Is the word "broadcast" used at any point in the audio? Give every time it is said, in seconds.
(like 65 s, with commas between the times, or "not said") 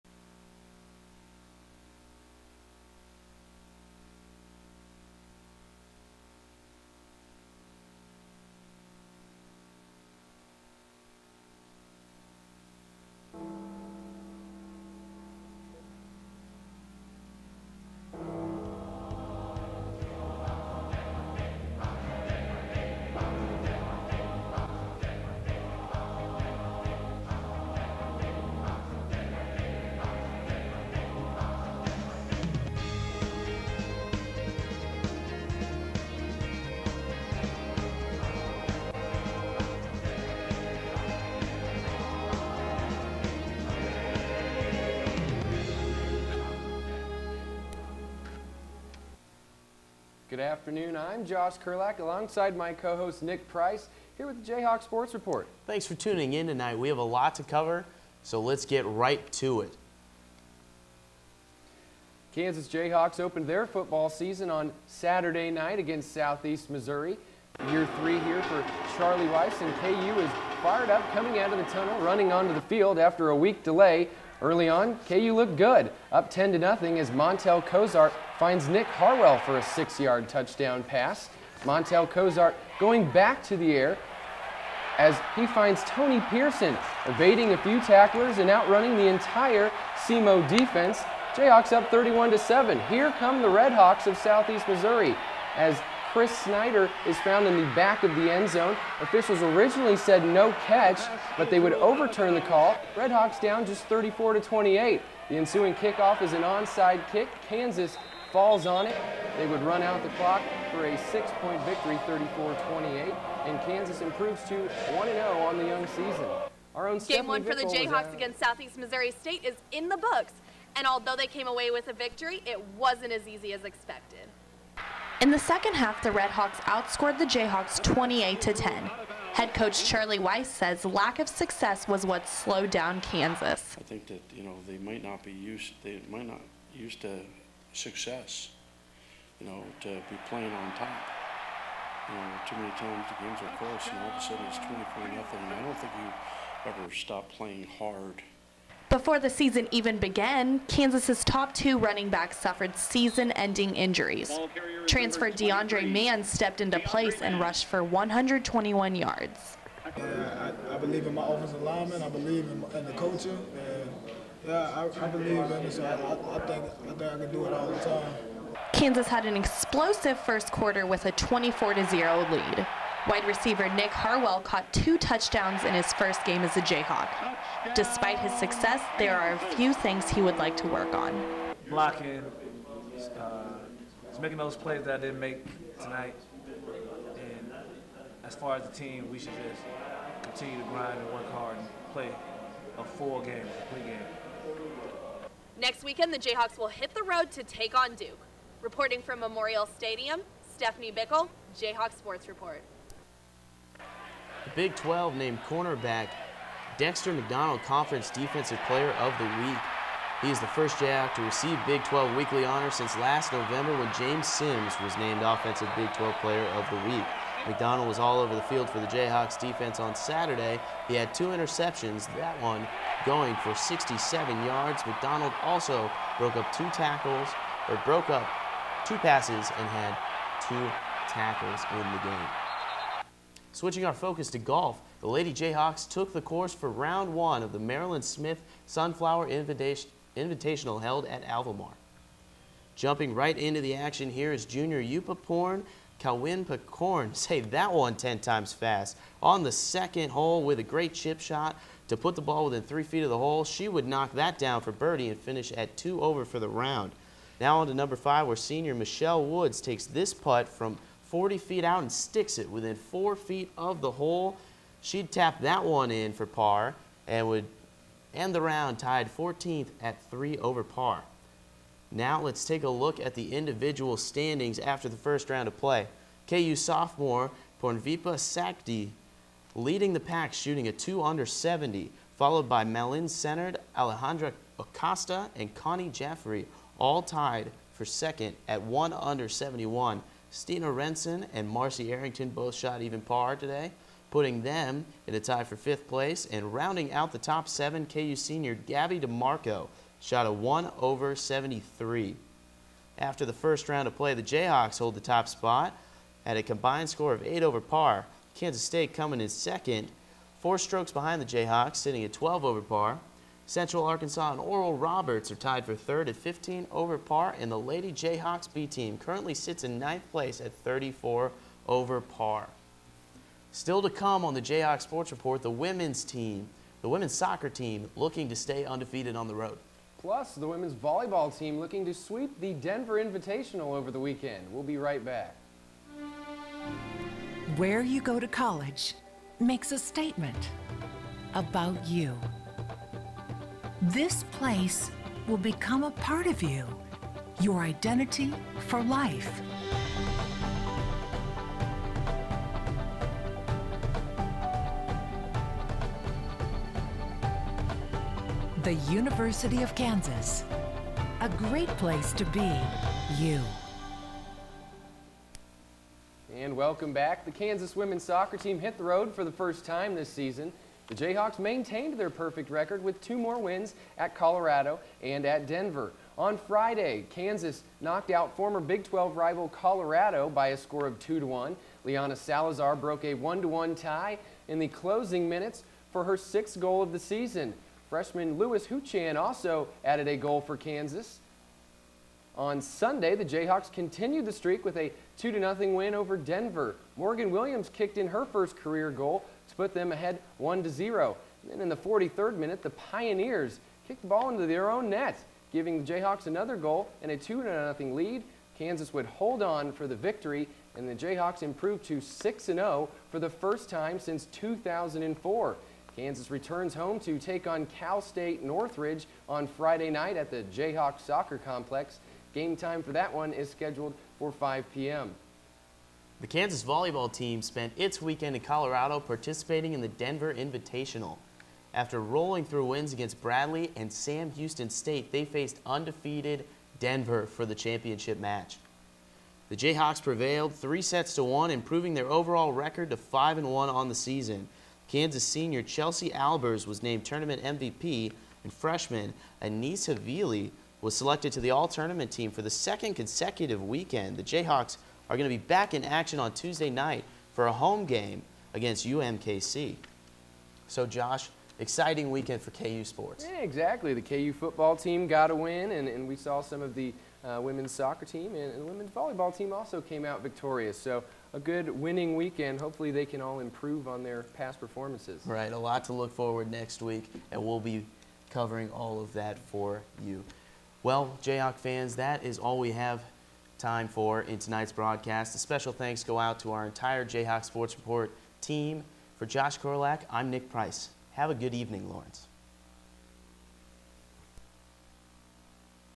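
484 s.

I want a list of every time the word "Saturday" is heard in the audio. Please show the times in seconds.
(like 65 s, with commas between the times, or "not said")
64 s, 219 s.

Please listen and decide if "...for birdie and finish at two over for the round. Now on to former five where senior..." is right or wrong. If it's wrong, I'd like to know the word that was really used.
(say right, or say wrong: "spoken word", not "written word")
wrong: "number", not "former".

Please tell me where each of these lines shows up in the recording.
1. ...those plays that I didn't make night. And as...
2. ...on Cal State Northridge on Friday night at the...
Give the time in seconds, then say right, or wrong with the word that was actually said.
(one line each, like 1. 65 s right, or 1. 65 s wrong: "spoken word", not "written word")
1. 184 s wrong: "tonight", not "night"
2. 417 s right.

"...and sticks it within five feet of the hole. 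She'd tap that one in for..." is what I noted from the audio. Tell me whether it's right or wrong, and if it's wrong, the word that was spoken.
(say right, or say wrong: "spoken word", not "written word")
wrong: "four", not "five".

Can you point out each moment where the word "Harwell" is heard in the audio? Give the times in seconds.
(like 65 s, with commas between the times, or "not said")
78 s, 173 s.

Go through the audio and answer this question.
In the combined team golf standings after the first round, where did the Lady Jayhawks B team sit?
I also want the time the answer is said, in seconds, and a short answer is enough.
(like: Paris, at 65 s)
ninth place, at 319 s.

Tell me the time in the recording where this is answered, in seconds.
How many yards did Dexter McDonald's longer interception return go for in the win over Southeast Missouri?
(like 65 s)
223 s.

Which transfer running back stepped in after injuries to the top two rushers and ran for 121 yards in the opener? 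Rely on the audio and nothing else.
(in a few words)
DeAndre Mann.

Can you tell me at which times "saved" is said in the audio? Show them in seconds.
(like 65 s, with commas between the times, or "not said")
247 s.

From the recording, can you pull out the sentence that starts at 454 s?
The Jayhawks are going to be back in action on Tuesday night for a home game against UMKC.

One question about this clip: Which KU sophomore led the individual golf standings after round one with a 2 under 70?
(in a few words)
Pornvipa Sakdee.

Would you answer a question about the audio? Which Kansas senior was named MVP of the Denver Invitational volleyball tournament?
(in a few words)
Chelsea Albers.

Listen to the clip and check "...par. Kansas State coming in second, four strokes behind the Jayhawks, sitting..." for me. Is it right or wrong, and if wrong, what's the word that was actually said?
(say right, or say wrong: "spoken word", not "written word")
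right.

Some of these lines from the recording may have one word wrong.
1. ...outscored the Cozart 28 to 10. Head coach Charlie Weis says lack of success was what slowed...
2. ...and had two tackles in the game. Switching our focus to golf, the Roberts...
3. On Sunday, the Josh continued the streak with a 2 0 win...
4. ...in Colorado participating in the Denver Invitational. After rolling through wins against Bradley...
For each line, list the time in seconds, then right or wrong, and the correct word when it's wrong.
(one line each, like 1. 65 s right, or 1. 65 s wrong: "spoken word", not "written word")
1. 126 s wrong: "Jayhawks", not "Cozart"
2. 229 s wrong: "Lady", not "Roberts"
3. 392 s wrong: "Jayhawks", not "Josh"
4. 428 s right.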